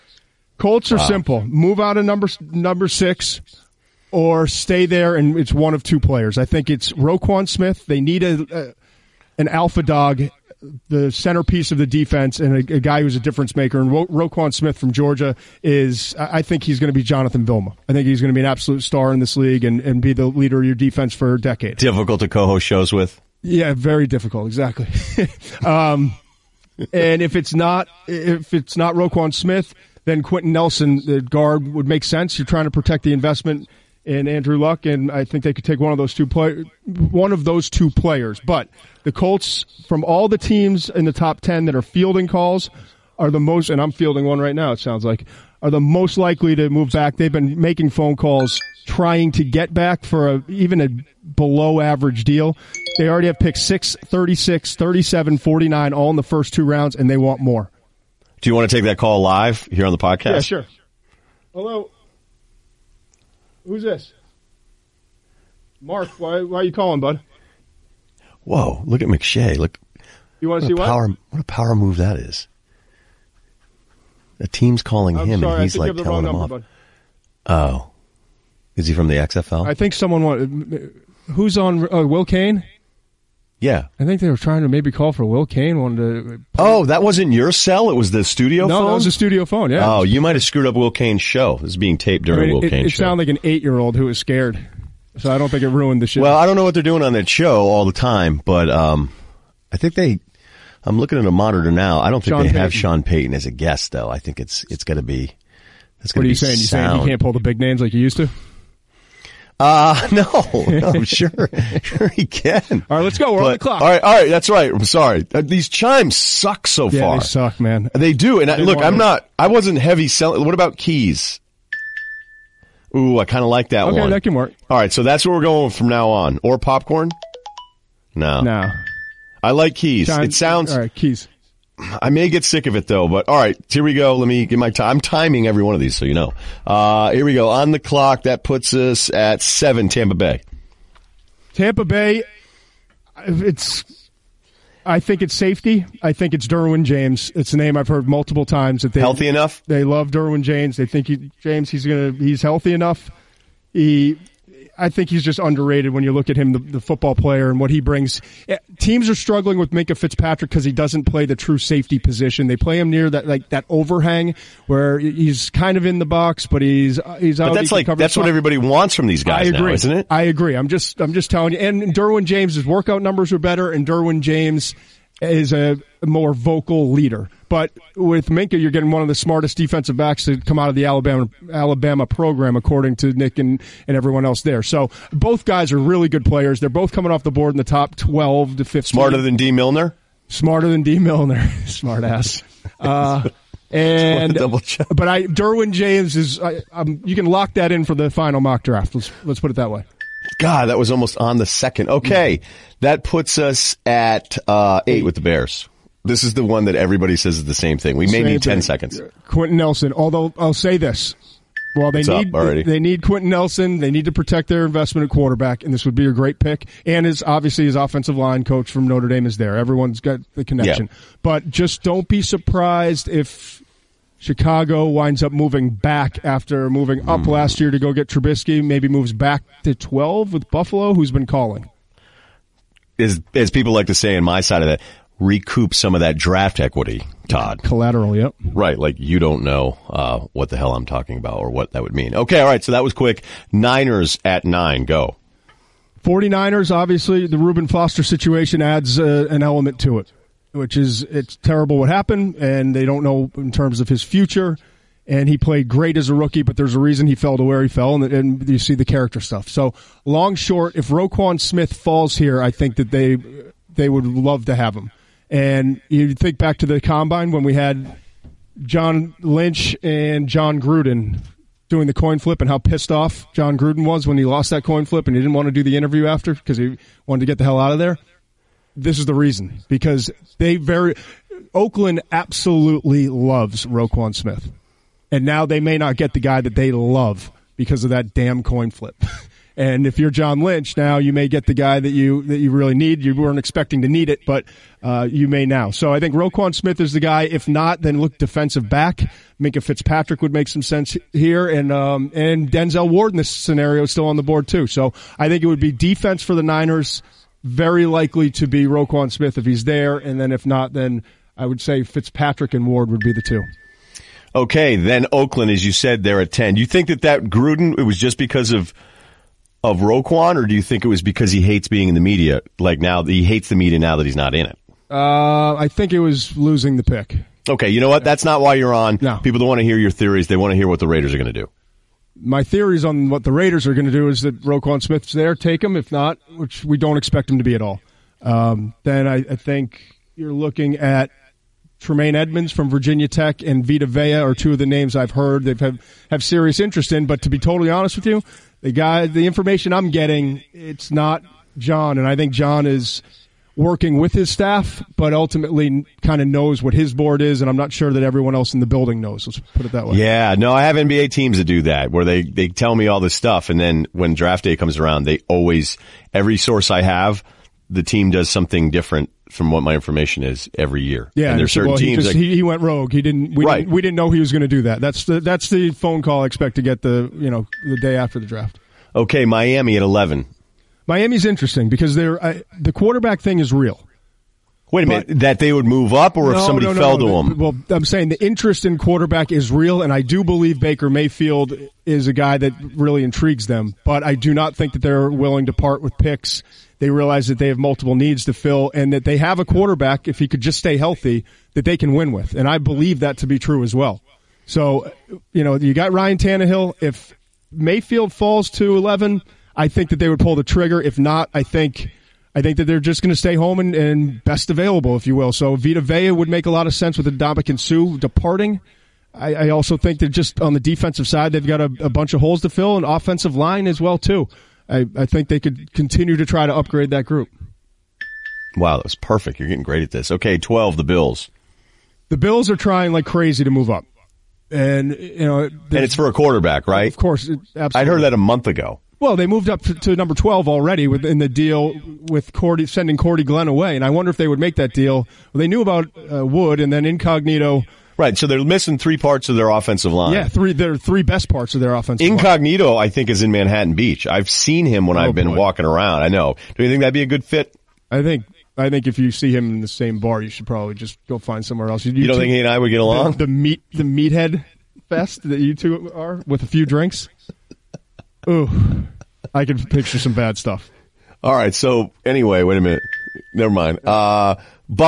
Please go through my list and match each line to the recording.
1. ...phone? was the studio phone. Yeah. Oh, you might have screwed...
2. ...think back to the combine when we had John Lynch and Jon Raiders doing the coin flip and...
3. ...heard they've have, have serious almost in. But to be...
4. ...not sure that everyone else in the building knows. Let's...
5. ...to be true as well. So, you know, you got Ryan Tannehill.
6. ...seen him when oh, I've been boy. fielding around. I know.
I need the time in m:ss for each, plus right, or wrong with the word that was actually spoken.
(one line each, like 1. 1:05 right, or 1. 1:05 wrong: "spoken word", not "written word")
1. 1:28 right
2. 4:26 wrong: "Gruden", not "Raiders"
3. 5:45 wrong: "interest", not "almost"
4. 5:57 right
5. 6:43 right
6. 7:34 wrong: "walking", not "fielding".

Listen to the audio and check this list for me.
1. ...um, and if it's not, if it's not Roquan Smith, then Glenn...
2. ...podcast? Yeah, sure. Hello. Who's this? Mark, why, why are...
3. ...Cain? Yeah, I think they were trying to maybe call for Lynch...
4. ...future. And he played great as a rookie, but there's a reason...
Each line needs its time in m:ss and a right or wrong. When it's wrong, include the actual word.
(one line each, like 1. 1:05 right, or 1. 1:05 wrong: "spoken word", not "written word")
1. 0:25 wrong: "Quenton", not "Glenn"
2. 0:59 right
3. 1:22 wrong: "Will", not "Lynch"
4. 4:14 right.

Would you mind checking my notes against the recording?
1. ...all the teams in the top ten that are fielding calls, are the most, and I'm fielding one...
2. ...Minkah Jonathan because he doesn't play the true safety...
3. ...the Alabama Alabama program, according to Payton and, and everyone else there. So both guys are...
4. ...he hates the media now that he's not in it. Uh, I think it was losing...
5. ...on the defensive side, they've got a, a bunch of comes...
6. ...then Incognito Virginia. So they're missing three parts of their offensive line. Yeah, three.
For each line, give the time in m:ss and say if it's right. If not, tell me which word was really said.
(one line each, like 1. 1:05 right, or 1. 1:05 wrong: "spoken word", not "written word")
1. 0:40 right
2. 2:39 wrong: "Fitzpatrick", not "Jonathan"
3. 3:00 wrong: "Nick", not "Payton"
4. 5:23 right
5. 7:00 wrong: "holes", not "comes"
6. 7:26 wrong: "Right", not "Virginia".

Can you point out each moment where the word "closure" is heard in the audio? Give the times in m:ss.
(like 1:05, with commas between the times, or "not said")
not said.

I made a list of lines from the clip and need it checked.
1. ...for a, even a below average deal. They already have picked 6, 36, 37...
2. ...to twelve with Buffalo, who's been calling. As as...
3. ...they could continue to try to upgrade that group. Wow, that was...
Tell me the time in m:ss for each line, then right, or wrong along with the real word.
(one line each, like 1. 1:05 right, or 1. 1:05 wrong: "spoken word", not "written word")
1. 0:50 right
2. 3:49 right
3. 7:05 right.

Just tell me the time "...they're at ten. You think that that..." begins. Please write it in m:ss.
5:16.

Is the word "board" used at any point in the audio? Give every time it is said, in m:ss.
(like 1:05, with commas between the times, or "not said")
3:07, 5:04, 5:56.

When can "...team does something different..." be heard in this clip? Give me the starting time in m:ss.
6:07.